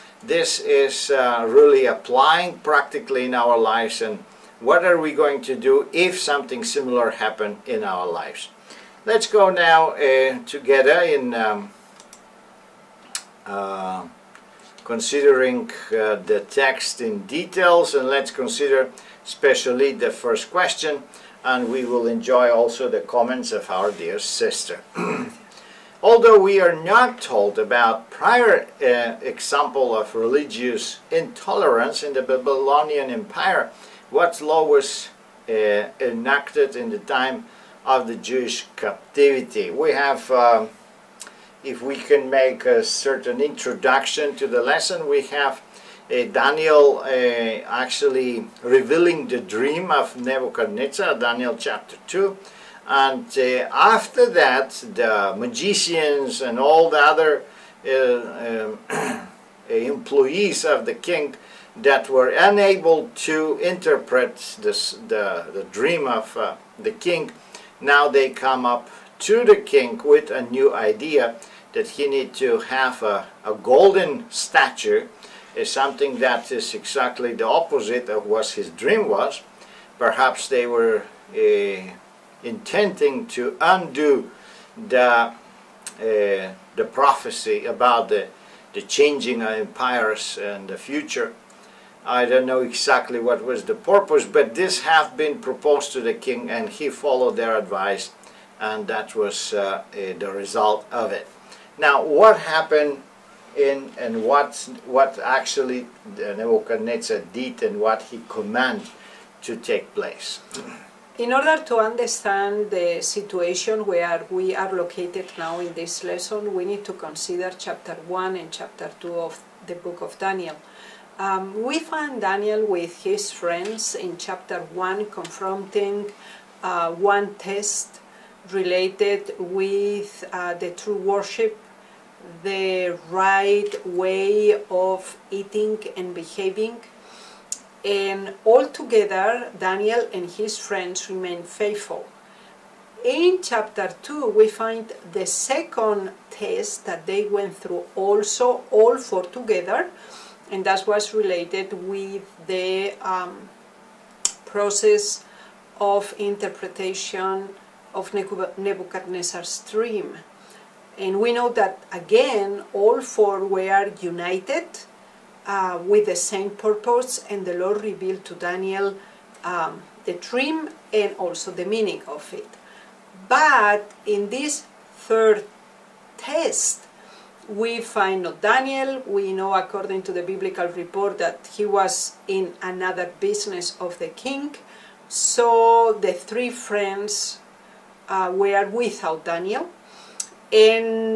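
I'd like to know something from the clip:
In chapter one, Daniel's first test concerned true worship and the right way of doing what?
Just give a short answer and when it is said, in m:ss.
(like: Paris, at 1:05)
Eating and behaving, at 2:15.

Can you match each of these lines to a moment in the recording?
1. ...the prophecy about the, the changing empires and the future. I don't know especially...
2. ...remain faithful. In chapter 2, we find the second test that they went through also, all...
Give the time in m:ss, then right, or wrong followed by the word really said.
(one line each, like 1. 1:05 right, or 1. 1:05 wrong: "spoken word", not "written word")
1. 1:25 wrong: "exactly", not "especially"
2. 2:21 right.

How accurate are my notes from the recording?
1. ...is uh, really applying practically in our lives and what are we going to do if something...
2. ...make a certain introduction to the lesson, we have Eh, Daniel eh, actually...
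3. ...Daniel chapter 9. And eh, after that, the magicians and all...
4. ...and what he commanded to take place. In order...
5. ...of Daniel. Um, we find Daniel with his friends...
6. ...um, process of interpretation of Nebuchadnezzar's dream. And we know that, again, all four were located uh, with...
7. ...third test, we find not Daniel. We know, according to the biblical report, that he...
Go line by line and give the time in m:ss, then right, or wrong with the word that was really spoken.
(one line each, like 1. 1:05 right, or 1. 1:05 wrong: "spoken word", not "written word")
1. 0:00 right
2. 0:42 right
3. 0:51 wrong: "2", not "9"
4. 1:47 right
5. 2:00 right
6. 2:33 wrong: "united", not "located"
7. 2:54 right.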